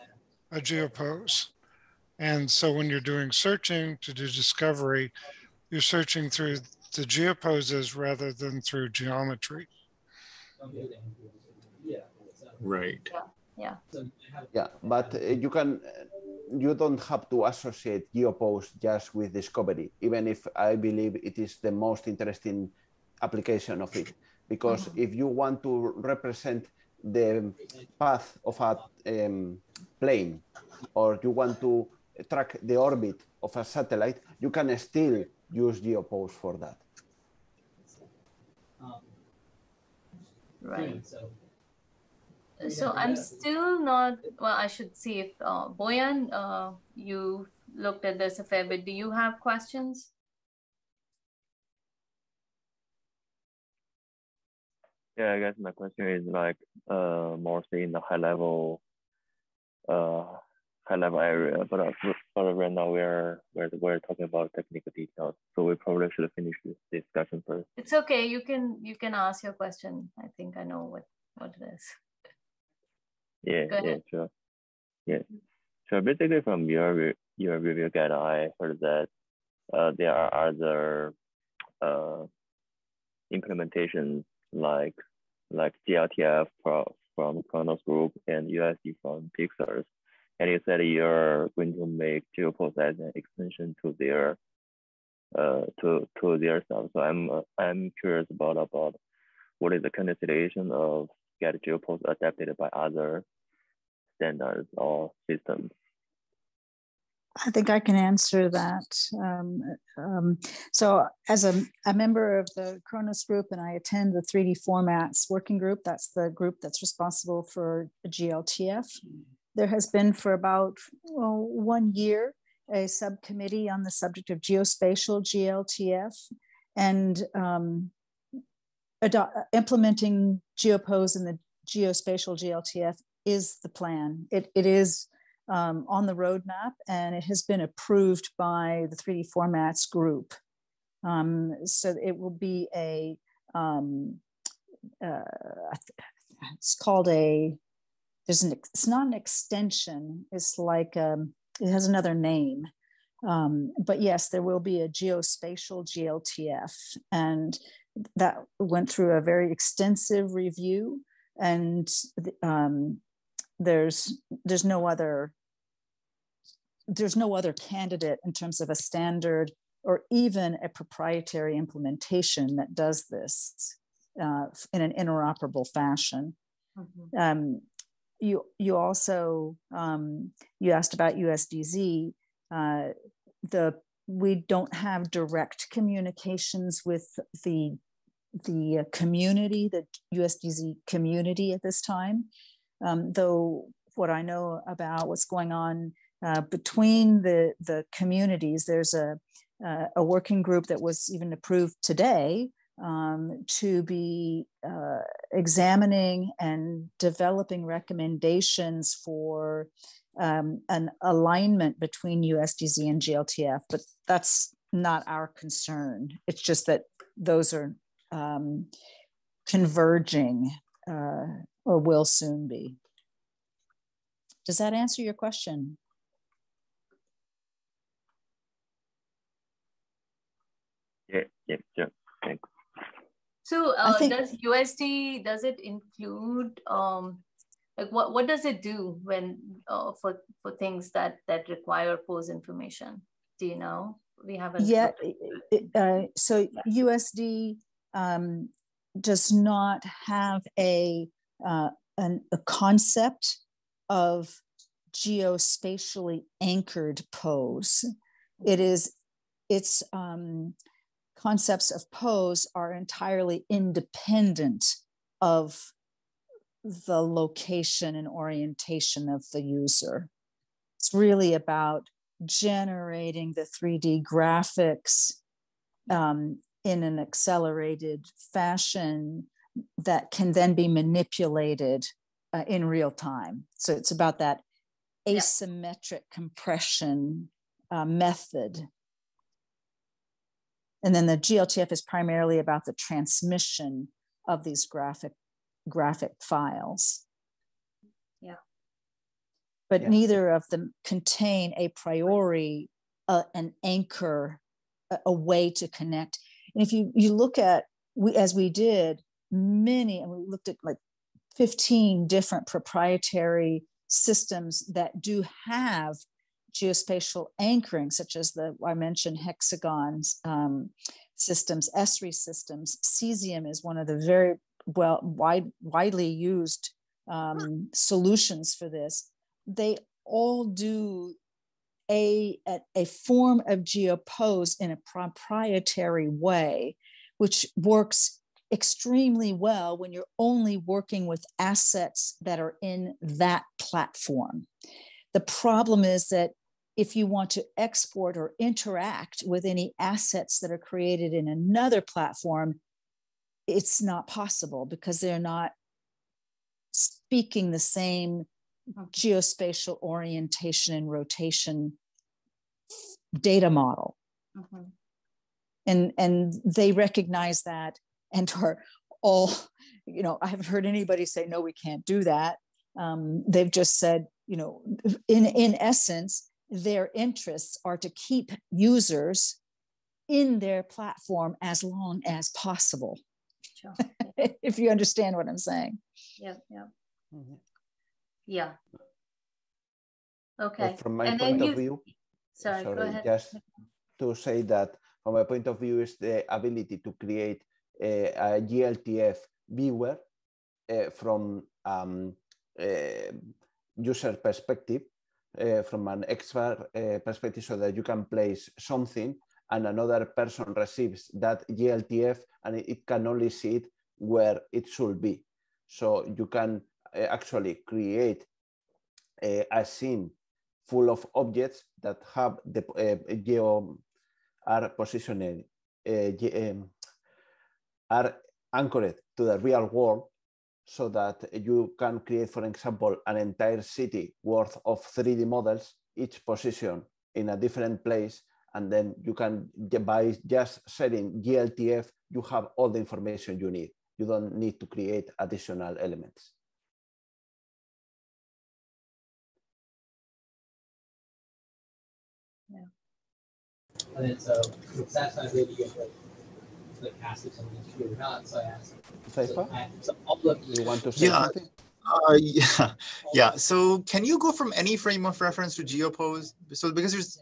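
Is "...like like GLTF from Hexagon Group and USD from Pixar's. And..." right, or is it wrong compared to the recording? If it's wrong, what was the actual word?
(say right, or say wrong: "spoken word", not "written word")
wrong: "Khronos", not "Hexagon".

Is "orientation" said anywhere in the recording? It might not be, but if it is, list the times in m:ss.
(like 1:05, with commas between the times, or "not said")
4:28, 5:59.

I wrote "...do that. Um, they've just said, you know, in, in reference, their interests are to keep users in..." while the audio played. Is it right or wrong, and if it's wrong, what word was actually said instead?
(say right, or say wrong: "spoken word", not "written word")
wrong: "essence", not "reference".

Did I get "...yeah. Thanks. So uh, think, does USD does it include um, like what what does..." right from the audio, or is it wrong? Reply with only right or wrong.
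right.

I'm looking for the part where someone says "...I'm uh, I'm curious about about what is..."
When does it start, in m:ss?
1:37.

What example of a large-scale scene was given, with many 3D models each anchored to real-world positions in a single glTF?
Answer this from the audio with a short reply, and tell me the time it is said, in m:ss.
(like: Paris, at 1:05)
An entire city, at 7:13.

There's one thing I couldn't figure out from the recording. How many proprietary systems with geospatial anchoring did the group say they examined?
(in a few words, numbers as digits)
15.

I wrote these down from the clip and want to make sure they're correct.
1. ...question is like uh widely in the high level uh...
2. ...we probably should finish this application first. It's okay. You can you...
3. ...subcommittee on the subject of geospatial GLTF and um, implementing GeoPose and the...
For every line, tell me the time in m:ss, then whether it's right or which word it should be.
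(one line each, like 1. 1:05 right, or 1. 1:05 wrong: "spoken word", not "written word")
1. 0:55 wrong: "mostly", not "widely"
2. 1:05 wrong: "discussion", not "application"
3. 2:02 right.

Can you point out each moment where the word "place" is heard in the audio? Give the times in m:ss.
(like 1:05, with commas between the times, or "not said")
6:48, 7:17.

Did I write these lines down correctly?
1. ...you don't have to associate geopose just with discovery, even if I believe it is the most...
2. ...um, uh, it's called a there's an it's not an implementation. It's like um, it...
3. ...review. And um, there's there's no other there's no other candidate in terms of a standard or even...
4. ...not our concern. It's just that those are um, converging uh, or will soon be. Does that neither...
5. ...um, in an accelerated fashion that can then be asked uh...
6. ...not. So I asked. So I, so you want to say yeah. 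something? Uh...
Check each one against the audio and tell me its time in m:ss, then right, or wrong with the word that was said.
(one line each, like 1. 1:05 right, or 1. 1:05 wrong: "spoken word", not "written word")
1. 0:16 right
2. 2:23 wrong: "extension", not "implementation"
3. 2:40 right
4. 3:34 wrong: "answer", not "neither"
5. 4:35 wrong: "manipulated", not "asked"
6. 7:37 right.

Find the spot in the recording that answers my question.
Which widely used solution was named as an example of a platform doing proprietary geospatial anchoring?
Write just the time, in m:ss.
5:22.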